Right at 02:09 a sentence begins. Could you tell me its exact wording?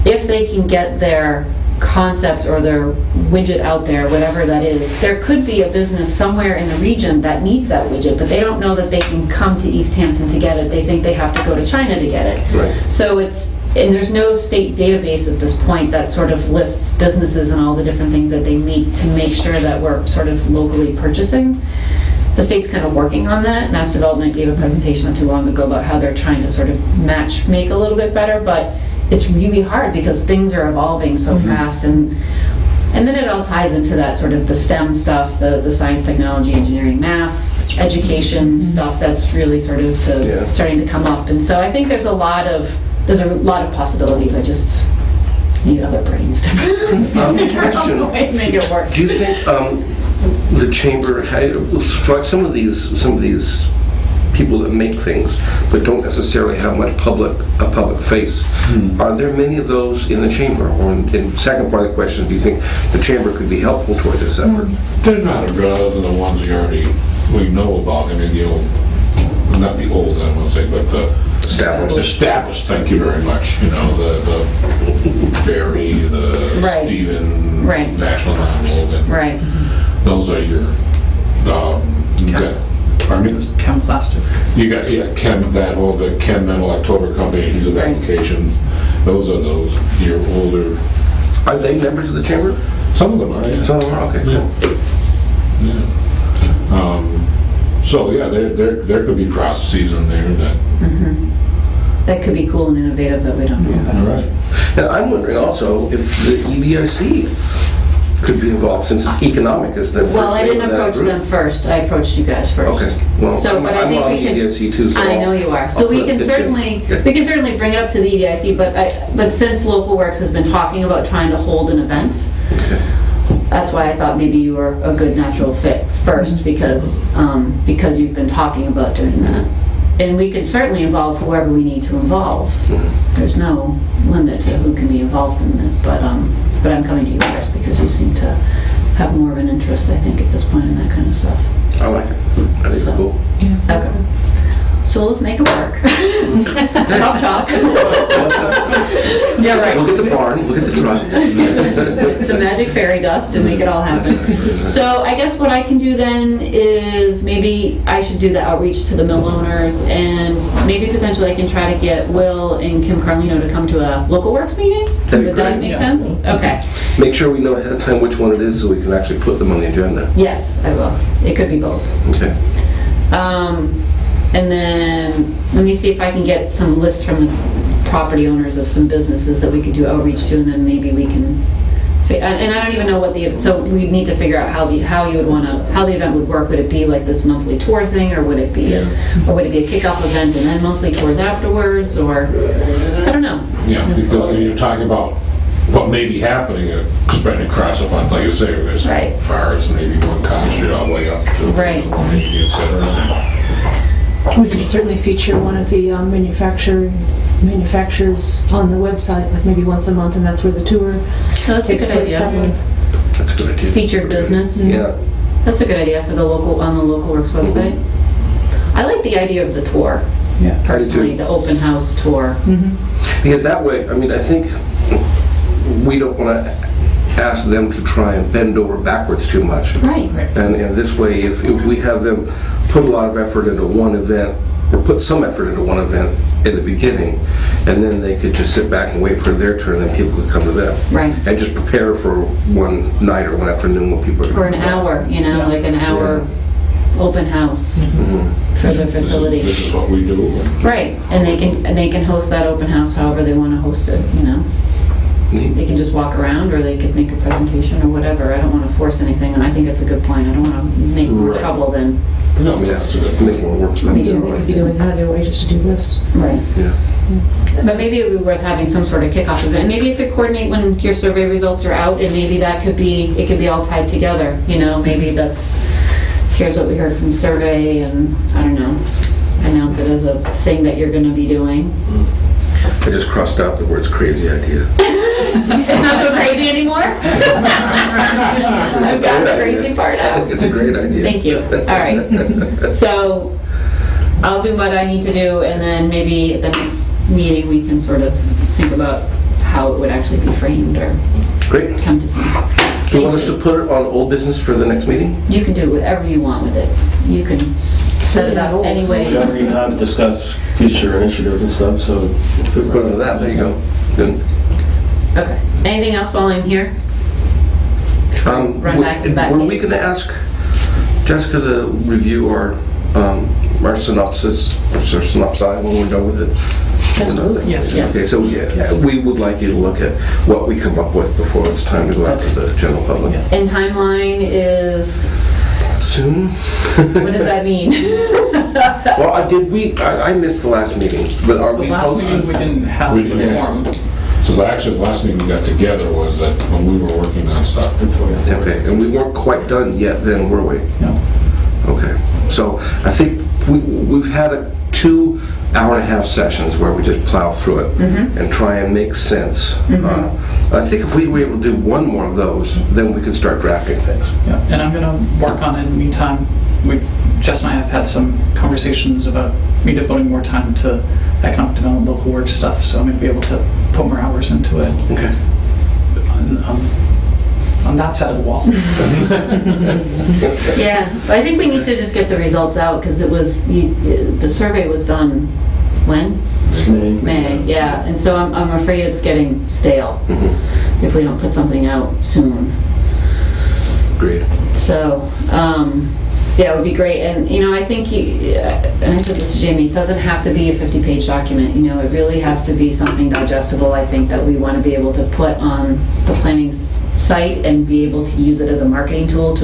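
And we can certainly involve whoever we need to involve.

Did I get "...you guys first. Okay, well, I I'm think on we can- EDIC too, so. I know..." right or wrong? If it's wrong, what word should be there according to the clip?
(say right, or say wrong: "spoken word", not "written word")
right.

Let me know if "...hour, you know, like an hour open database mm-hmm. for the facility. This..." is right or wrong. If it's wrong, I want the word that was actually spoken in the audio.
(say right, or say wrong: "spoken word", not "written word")
wrong: "house", not "database".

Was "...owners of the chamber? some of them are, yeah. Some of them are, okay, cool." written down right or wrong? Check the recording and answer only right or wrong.
wrong.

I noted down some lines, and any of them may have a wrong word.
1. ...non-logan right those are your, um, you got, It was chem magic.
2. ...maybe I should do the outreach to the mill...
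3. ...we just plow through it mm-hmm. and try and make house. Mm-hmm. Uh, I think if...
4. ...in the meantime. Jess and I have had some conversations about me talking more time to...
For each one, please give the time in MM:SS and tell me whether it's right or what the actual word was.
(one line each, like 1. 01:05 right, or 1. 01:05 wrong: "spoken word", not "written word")
1. 01:18 wrong: "plastic", not "magic"
2. 02:37 right
3. 05:56 wrong: "sense", not "house"
4. 06:05 wrong: "devoting", not "talking".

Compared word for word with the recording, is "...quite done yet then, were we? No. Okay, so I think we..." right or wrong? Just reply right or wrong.
right.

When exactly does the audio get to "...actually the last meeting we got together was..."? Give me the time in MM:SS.
05:44.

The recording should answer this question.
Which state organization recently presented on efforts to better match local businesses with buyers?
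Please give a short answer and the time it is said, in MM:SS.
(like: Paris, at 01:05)
Mass Development, at 00:23.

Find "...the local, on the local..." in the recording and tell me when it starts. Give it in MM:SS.
03:36.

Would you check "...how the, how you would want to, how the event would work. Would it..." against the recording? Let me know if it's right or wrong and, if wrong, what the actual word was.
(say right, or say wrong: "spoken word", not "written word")
right.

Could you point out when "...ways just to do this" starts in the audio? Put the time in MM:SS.
04:25.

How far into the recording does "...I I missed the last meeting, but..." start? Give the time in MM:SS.
05:39.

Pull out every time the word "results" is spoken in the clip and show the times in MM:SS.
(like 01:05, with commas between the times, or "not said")
04:31, 06:22.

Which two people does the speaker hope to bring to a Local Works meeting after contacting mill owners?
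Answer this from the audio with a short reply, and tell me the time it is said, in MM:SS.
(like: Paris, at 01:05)
Will and Kim Carlino, at 02:42.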